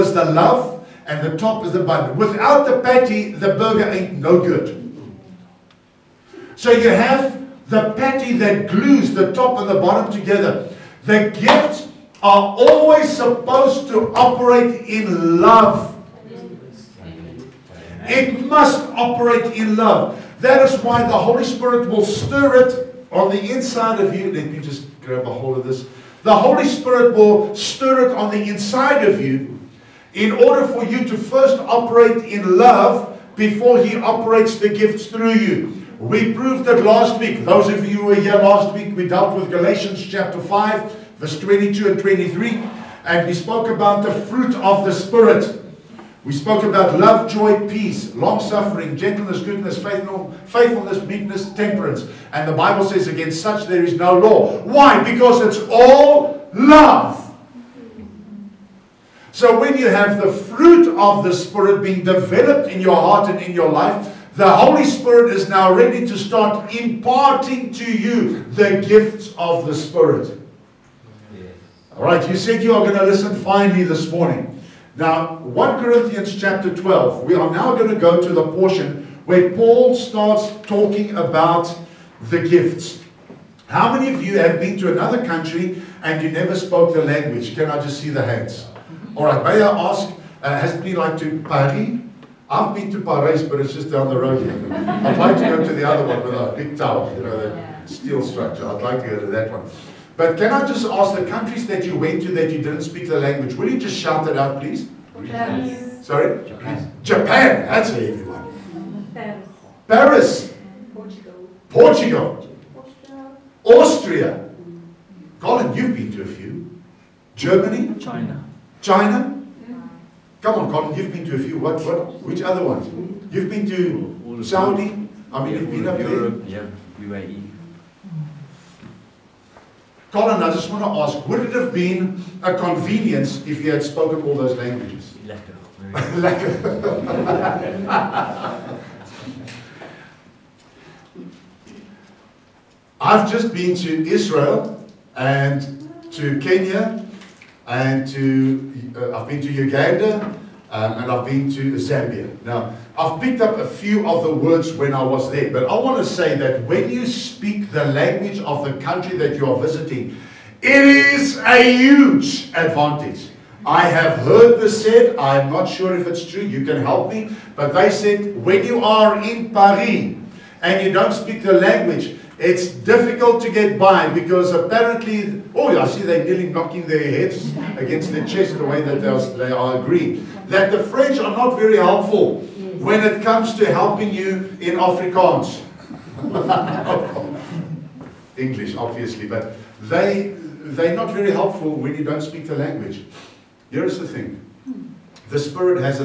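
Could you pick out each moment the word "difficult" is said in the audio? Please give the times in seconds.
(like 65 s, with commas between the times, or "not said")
172 s.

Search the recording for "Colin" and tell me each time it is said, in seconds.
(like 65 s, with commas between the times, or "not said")
115 s, 120 s, 130 s.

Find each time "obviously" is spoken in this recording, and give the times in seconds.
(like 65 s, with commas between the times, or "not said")
188 s.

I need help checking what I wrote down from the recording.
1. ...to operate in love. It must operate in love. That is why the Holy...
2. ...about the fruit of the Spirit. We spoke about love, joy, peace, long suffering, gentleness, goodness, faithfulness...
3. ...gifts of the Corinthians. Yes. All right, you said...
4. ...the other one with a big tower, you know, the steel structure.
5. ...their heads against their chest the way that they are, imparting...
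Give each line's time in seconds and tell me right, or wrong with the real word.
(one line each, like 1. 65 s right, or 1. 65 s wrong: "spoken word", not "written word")
1. 13 s right
2. 43 s right
3. 68 s wrong: "Spirit", not "Corinthians"
4. 95 s right
5. 176 s wrong: "agreeing", not "imparting".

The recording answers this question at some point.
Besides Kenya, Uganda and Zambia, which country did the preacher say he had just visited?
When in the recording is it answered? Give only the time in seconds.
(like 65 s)
144 s.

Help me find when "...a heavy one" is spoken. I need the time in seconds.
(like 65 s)
107 s.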